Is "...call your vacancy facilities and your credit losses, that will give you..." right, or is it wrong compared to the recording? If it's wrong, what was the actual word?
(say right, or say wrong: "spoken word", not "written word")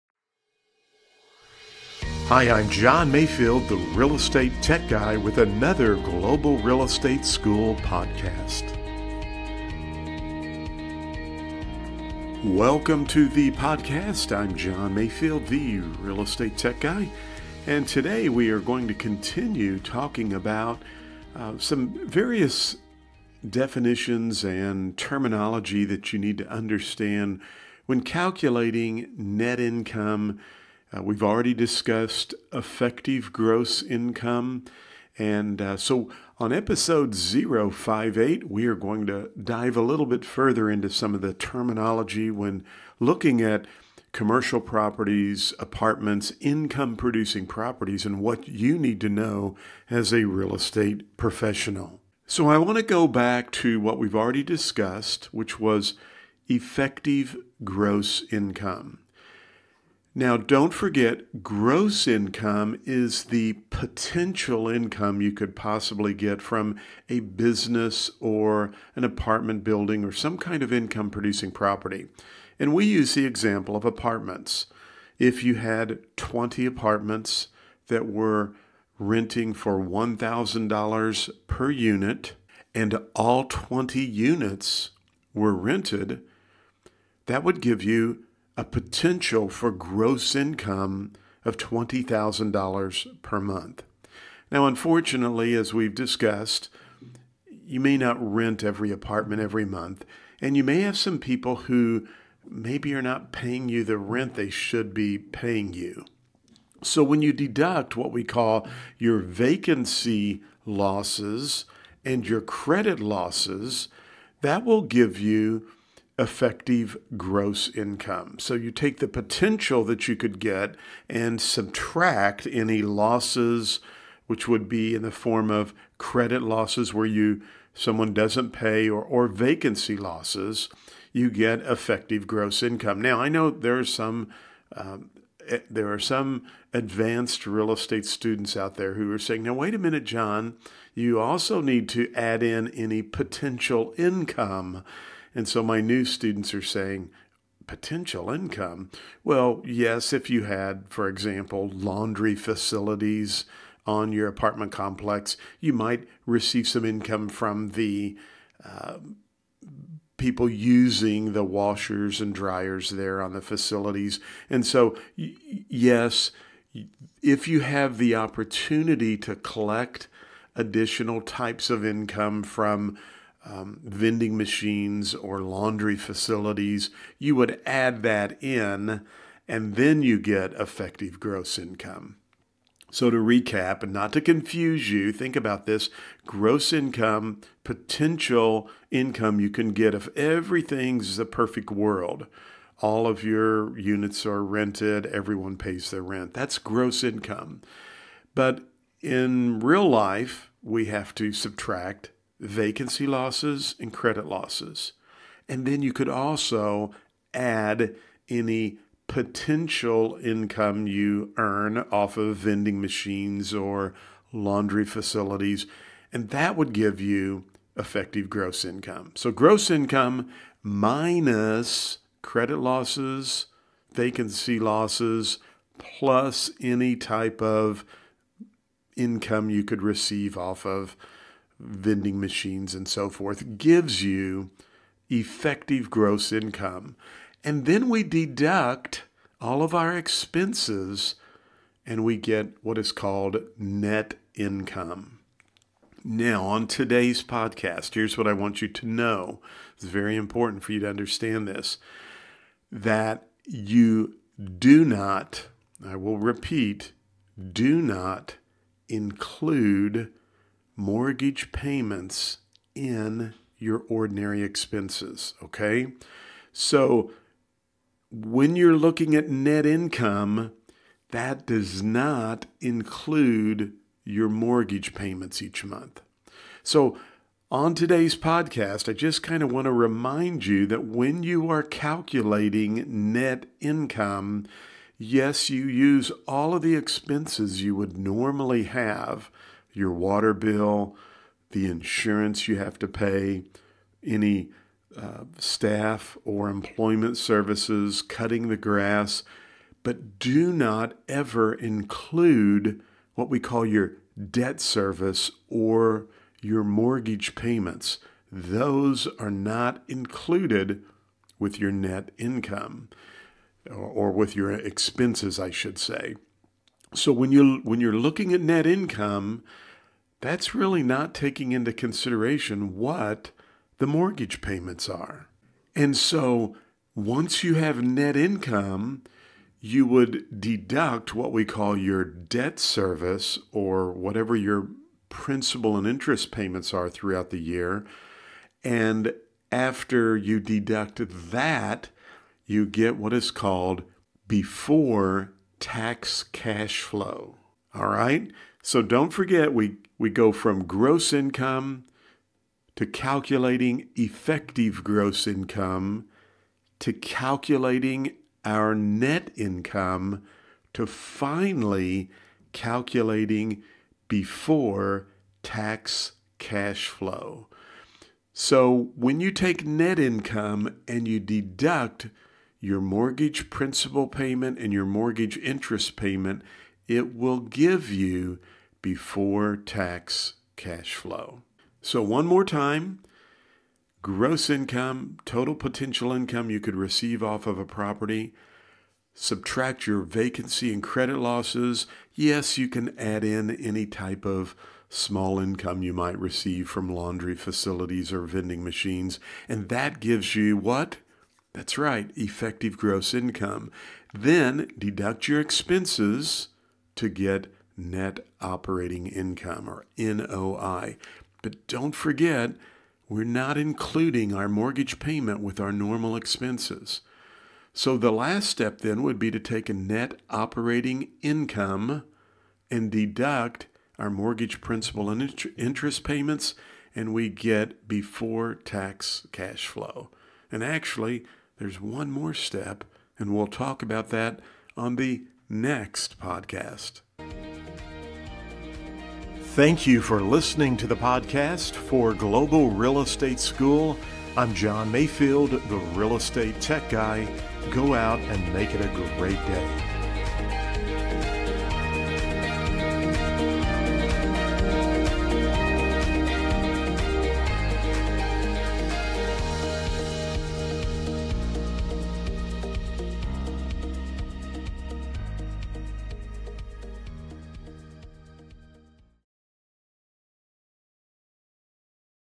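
wrong: "losses", not "facilities".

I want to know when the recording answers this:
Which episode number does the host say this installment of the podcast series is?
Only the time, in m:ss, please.
0:37.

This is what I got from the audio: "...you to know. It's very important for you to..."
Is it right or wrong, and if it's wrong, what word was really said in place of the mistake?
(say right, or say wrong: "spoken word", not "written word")
right.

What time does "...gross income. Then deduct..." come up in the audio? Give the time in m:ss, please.
6:42.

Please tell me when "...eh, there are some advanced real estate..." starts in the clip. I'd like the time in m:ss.
2:15.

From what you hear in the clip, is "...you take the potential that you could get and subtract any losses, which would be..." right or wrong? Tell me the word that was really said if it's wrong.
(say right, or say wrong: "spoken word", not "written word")
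right.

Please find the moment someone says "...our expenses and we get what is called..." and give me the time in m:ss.
3:59.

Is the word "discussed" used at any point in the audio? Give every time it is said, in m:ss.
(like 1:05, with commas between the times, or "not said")
0:31, 0:54, 1:35.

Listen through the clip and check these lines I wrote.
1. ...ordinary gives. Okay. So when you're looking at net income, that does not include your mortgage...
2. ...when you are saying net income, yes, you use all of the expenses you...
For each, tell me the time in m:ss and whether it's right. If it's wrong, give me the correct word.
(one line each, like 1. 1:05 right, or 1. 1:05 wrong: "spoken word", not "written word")
1. 4:23 wrong: "expenses", not "gives"
2. 4:40 wrong: "calculating", not "saying".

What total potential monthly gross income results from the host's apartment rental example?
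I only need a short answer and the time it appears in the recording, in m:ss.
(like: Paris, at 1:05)
$20,000, at 1:31.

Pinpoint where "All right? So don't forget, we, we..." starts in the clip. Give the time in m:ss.
5:47.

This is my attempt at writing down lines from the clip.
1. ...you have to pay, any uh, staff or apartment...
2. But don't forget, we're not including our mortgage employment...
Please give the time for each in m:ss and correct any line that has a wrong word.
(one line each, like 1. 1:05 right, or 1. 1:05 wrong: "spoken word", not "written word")
1. 4:52 wrong: "employment", not "apartment"
2. 6:51 wrong: "payment", not "employment".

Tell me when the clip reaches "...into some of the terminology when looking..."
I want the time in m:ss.
0:40.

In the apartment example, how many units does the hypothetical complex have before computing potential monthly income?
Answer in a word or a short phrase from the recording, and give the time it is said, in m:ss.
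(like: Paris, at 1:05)
20, at 1:16.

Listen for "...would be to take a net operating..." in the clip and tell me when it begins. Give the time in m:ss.
6:59.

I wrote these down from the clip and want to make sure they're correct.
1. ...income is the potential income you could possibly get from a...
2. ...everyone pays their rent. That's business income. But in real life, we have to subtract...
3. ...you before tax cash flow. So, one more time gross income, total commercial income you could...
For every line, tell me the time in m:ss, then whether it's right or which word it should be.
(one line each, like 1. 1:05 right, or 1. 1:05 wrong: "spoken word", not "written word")
1. 1:02 right
2. 3:15 wrong: "gross", not "business"
3. 6:17 wrong: "potential", not "commercial".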